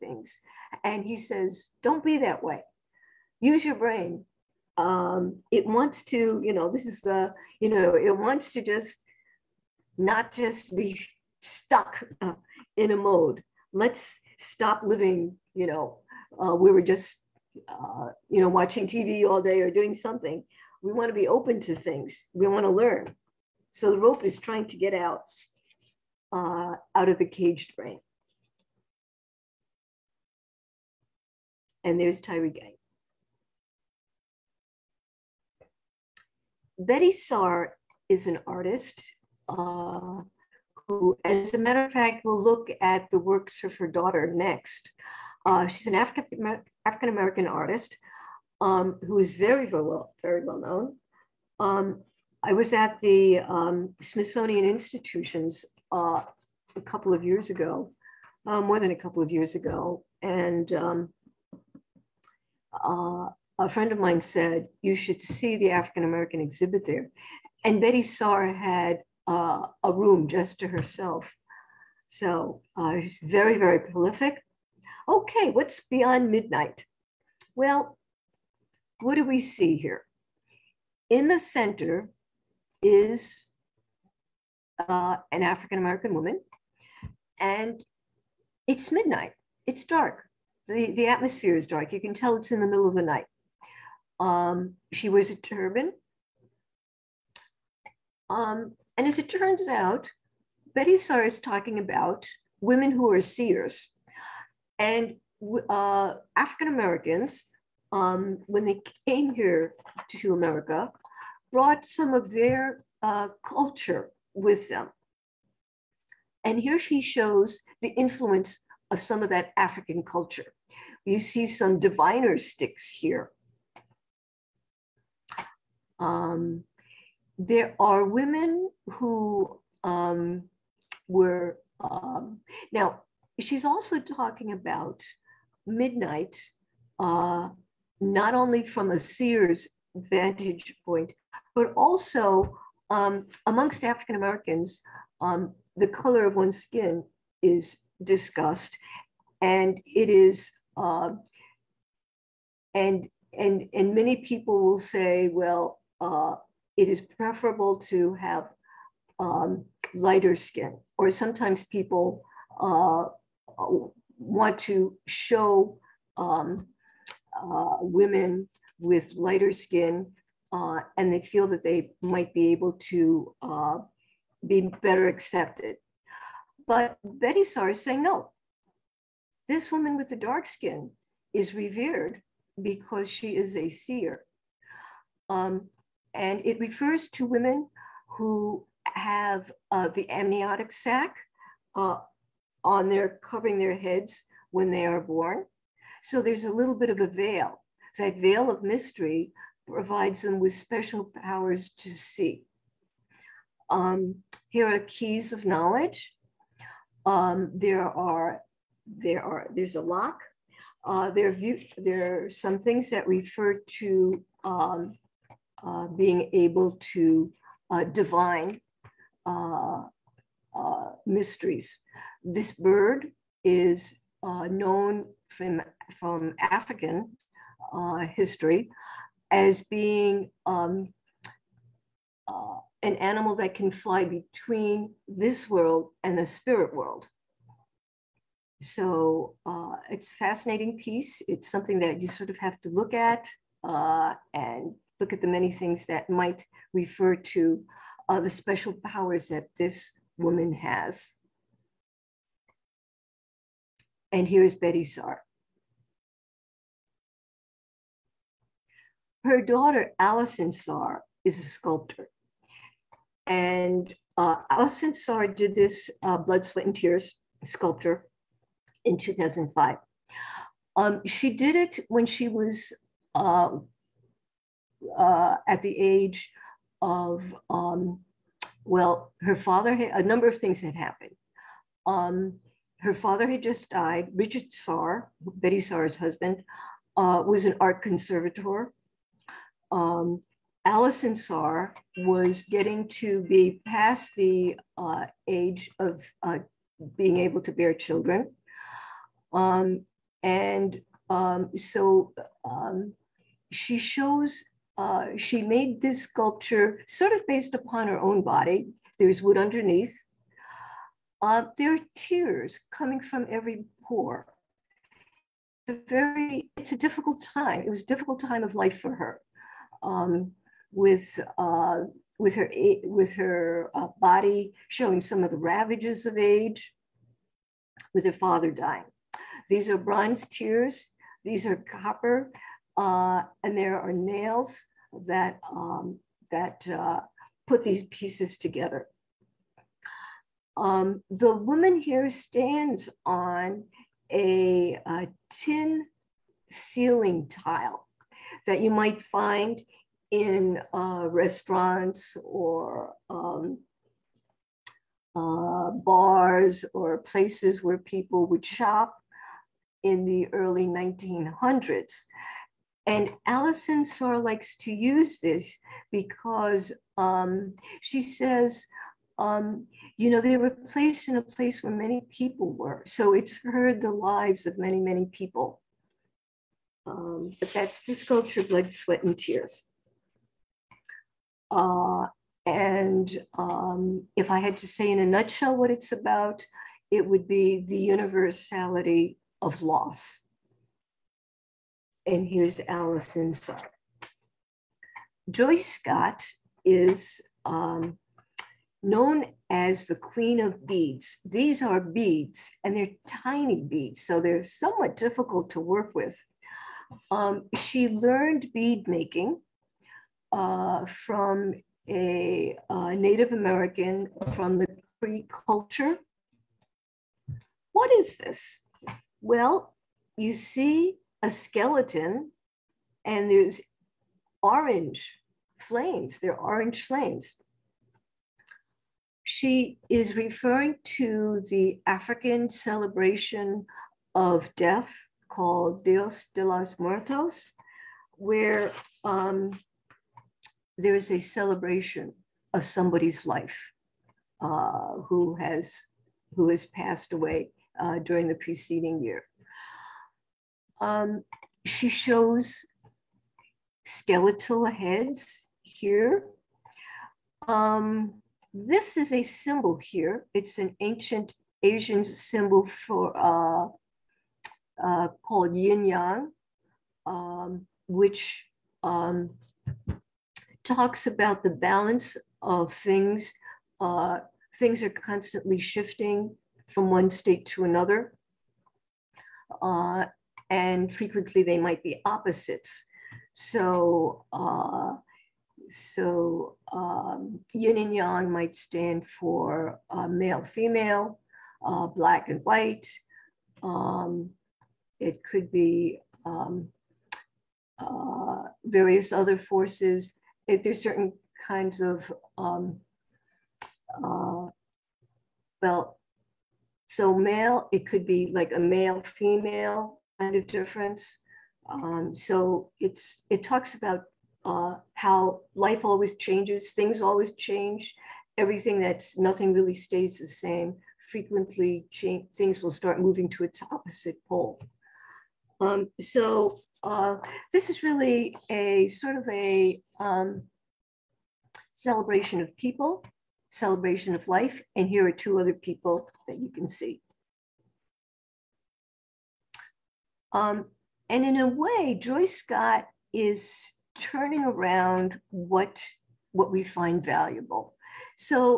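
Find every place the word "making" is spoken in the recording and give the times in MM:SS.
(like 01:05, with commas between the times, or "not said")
06:48.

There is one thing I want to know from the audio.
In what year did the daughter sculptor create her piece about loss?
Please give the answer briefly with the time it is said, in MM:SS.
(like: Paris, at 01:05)
2005, at 04:28.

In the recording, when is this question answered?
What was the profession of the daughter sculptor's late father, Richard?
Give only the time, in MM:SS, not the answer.
04:47.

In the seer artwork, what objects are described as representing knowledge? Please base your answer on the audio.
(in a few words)
Keys.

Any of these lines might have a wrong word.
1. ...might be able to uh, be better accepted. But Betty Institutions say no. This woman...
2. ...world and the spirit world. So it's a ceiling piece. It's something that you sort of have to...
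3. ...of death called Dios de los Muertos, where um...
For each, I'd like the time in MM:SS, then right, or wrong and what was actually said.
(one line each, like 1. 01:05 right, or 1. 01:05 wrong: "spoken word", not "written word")
1. 02:52 wrong: "Sars", not "Institutions"
2. 03:55 wrong: "fascinating", not "ceiling"
3. 07:14 right.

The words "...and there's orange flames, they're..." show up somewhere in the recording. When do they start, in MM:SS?
07:03.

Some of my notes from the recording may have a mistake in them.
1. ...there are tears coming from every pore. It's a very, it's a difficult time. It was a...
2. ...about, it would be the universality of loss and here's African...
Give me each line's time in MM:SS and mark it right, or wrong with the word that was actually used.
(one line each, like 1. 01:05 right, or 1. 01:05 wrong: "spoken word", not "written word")
1. 05:11 right
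2. 06:25 wrong: "Alice", not "African".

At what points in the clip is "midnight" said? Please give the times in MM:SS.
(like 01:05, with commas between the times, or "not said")
01:16, 01:28, 02:15.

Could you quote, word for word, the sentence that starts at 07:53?
Uh, things are constantly shifting from one state to another.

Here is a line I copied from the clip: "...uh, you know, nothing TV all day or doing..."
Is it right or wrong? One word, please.
wrong.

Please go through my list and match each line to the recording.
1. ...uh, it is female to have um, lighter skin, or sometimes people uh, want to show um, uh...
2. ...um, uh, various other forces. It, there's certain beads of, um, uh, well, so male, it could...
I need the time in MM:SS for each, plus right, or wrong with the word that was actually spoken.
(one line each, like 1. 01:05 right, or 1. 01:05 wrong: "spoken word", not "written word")
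1. 02:36 wrong: "preferable", not "female"
2. 08:16 wrong: "kinds", not "beads".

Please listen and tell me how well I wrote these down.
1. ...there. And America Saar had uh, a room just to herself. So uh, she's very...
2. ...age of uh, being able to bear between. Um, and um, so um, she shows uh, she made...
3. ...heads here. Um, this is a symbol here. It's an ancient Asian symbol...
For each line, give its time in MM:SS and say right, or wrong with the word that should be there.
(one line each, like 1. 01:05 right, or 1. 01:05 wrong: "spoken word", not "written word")
1. 01:06 wrong: "Betty", not "America"
2. 04:55 wrong: "children", not "between"
3. 07:34 right.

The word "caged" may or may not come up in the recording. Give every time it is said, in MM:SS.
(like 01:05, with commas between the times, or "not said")
00:27.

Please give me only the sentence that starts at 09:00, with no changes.
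Um, and in a way, Joy Scott is turning around what what we find valuable.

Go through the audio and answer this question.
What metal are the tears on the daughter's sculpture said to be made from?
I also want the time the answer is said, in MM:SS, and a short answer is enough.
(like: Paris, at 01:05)
Copper, at 05:31.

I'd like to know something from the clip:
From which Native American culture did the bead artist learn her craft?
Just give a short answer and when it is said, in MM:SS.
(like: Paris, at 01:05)
Cree, at 06:55.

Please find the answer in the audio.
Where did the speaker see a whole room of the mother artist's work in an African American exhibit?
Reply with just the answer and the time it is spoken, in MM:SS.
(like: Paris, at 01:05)
Smithsonian Institutions, at 00:54.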